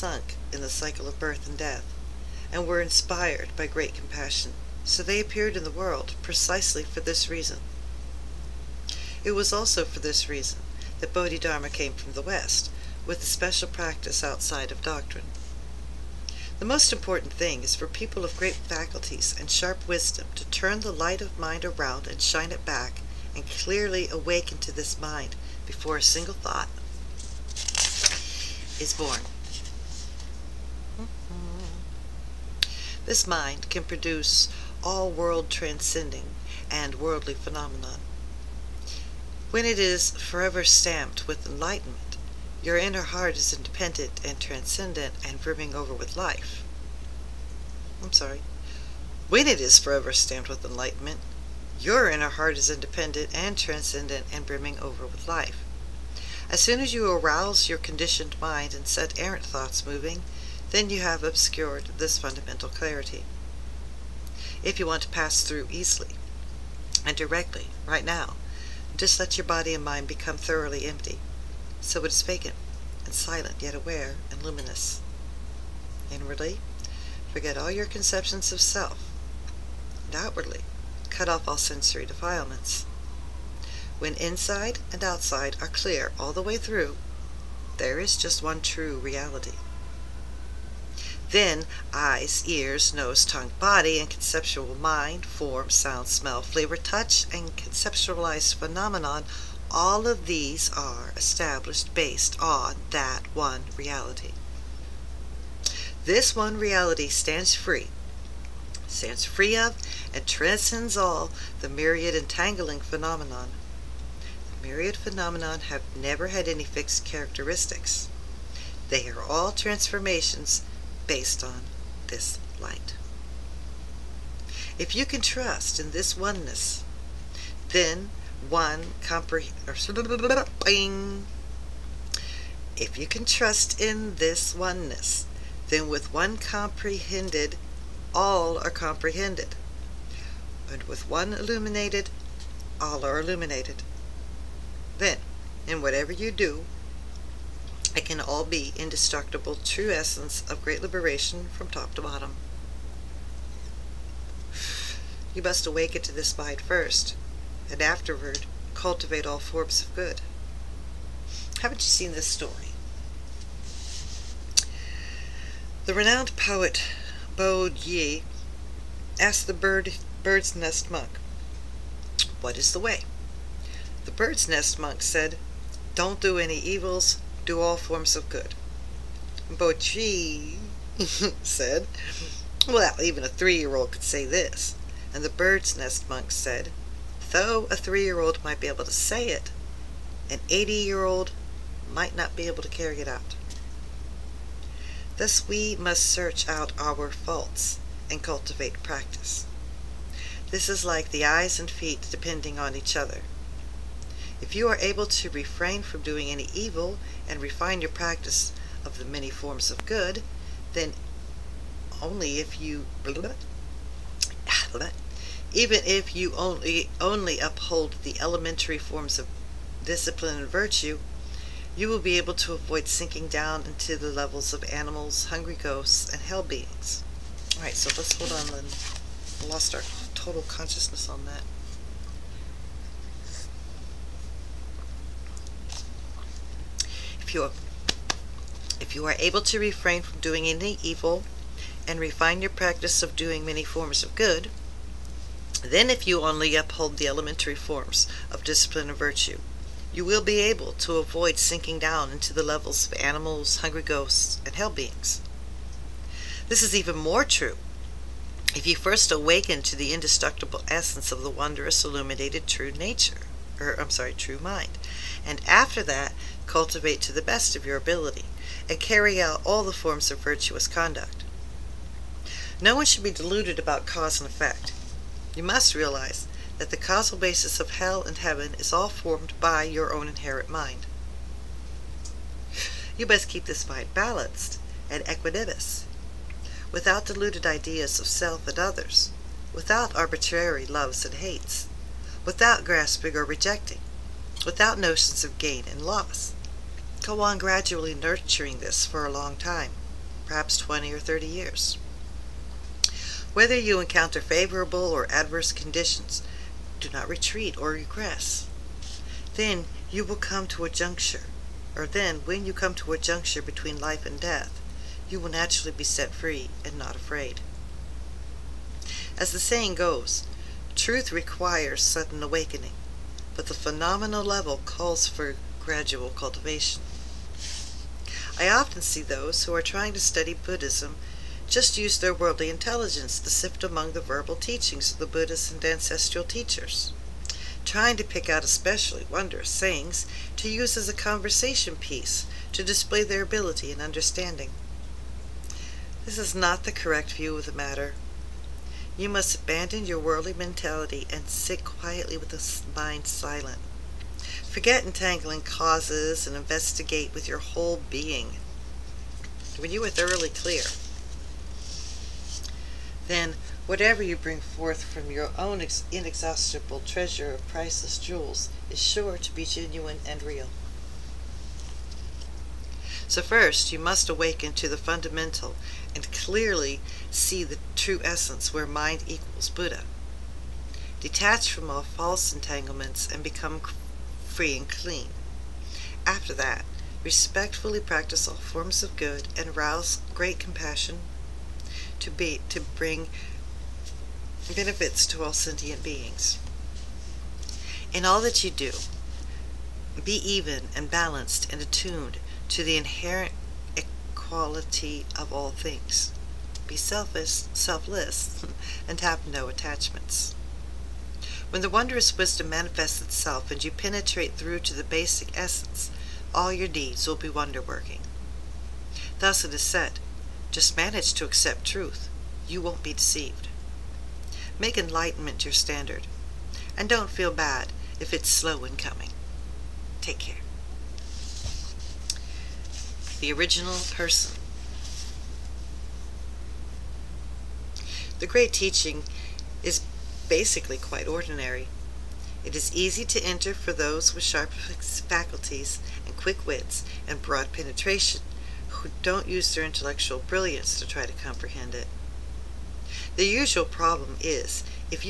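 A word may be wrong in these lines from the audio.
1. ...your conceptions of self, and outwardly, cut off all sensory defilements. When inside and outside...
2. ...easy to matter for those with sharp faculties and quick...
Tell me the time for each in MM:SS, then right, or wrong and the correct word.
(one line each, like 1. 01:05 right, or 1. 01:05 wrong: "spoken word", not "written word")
1. 01:17 right
2. 07:22 wrong: "enter", not "matter".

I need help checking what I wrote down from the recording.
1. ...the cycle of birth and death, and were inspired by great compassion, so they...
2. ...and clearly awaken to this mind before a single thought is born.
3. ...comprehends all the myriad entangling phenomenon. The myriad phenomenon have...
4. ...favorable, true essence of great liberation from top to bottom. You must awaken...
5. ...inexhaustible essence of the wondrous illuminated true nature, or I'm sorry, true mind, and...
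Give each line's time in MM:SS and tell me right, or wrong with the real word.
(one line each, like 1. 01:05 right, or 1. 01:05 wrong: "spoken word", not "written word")
1. 00:00 right
2. 00:23 right
3. 01:50 wrong: "transcends", not "comprehends"
4. 02:28 wrong: "indestructible", not "favorable"
5. 04:19 wrong: "indestructible", not "inexhaustible".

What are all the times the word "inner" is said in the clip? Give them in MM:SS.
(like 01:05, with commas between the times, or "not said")
00:42, 00:52.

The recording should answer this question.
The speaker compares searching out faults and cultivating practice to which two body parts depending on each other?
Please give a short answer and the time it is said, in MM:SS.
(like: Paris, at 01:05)
Eyes and feet, at 03:21.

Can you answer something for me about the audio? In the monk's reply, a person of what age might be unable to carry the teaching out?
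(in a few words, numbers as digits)
80.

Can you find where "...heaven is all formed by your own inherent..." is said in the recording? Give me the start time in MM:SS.
04:38.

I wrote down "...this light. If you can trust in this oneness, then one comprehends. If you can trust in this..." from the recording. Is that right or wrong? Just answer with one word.
right.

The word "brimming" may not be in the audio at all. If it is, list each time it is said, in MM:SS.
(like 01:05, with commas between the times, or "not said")
00:45, 00:54.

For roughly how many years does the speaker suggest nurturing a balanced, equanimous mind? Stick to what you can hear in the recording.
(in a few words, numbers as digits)
20 or 30 years.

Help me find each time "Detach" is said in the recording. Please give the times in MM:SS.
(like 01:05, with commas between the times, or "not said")
06:21.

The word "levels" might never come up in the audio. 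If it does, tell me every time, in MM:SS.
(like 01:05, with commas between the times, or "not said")
03:44, 04:12, 05:24.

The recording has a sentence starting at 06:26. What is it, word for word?
After that, respectfully practice all forms of good and rouse great compassion to be to bring benefits to all sentient beings.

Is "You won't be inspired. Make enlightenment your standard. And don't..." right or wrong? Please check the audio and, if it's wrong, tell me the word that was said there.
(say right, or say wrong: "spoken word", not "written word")
wrong: "deceived", not "inspired".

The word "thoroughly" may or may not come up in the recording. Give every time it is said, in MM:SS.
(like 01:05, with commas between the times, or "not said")
01:10, 05:59.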